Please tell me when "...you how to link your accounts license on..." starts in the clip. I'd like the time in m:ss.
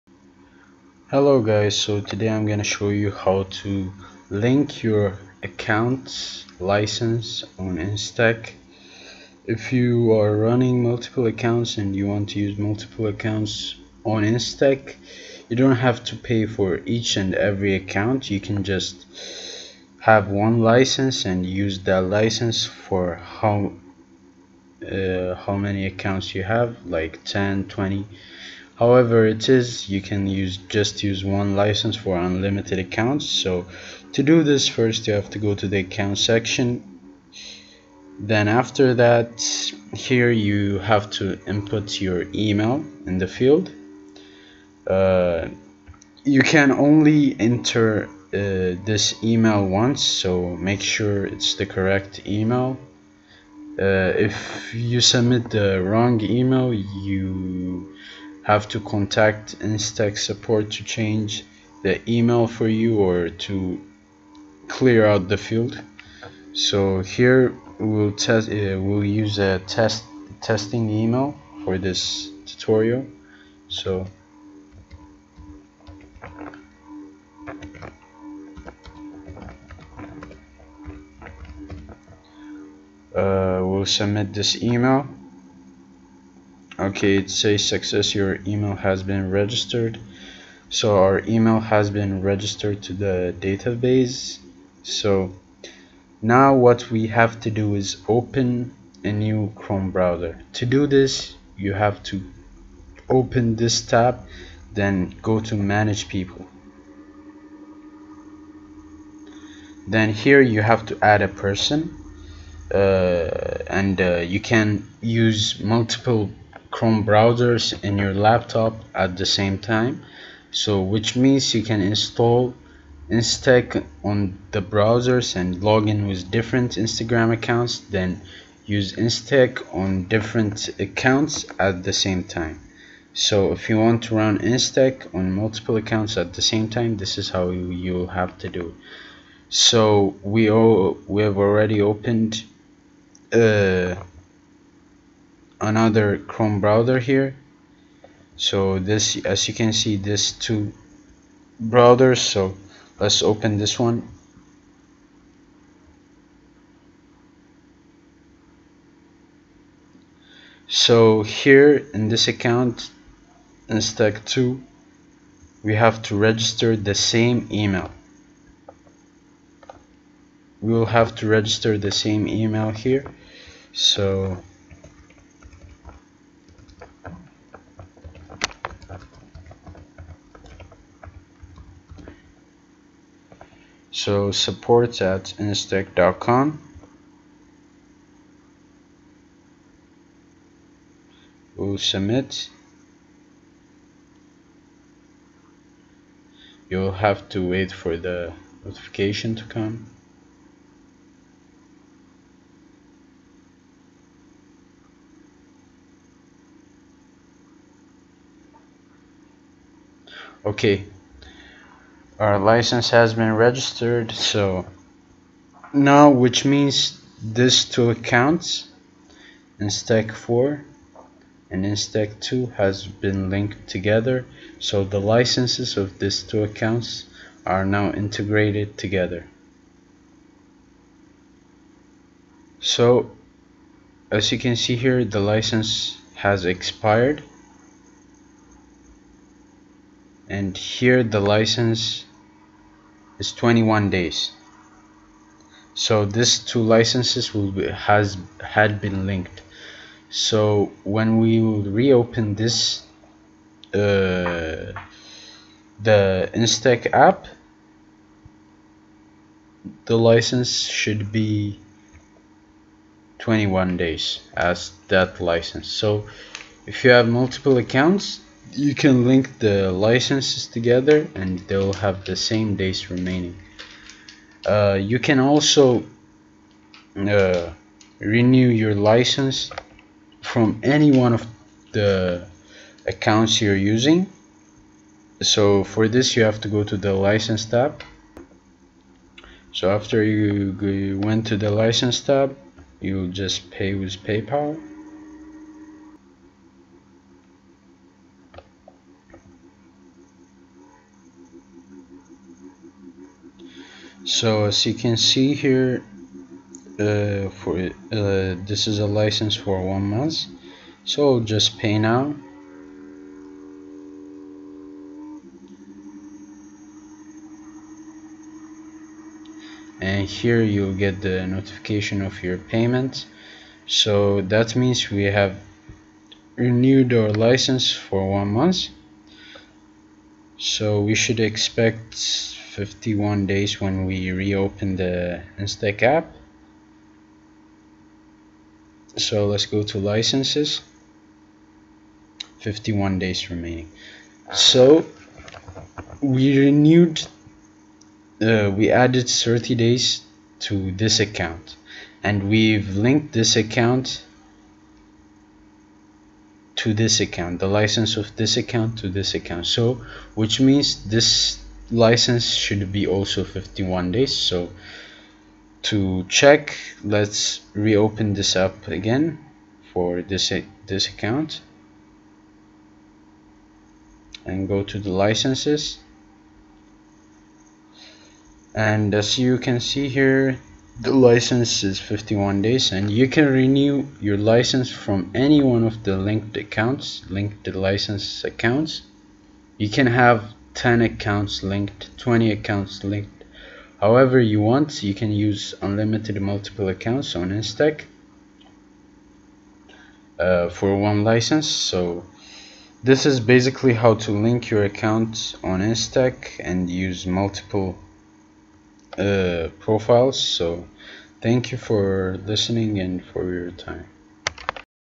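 0:02.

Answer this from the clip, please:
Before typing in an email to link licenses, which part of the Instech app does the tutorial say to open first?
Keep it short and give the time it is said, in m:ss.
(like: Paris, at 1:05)
account section, at 0:35.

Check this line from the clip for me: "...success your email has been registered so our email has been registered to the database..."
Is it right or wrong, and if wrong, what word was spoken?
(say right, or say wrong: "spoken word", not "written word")
right.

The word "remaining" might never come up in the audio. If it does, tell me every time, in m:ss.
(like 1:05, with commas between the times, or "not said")
4:32, 5:43.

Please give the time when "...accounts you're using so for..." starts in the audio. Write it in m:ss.
4:42.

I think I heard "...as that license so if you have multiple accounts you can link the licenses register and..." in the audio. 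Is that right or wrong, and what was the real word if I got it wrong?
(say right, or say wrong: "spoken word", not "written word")
wrong: "together", not "register".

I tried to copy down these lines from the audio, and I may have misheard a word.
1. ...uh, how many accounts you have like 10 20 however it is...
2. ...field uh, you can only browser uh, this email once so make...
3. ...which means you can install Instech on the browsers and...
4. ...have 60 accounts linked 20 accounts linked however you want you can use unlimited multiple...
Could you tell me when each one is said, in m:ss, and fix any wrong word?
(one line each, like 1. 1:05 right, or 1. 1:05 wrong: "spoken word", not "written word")
1. 0:24 right
2. 0:43 wrong: "enter", not "browser"
3. 2:00 right
4. 6:29 wrong: "10", not "60".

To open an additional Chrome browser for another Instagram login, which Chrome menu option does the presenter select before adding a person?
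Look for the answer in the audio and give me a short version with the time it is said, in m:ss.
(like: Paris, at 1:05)
Manage people, at 1:45.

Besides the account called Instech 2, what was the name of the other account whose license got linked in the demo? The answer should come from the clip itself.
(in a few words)
Instech 4.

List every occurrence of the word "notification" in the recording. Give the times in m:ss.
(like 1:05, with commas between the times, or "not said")
3:18, 5:21.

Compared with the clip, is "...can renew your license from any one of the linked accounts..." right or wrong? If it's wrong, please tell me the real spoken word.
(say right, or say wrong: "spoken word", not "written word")
right.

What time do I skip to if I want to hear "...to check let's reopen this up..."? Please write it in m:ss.
6:05.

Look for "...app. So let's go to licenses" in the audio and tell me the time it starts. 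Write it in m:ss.
5:35.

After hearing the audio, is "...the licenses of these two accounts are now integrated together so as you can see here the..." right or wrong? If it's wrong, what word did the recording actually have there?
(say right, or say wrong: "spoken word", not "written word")
right.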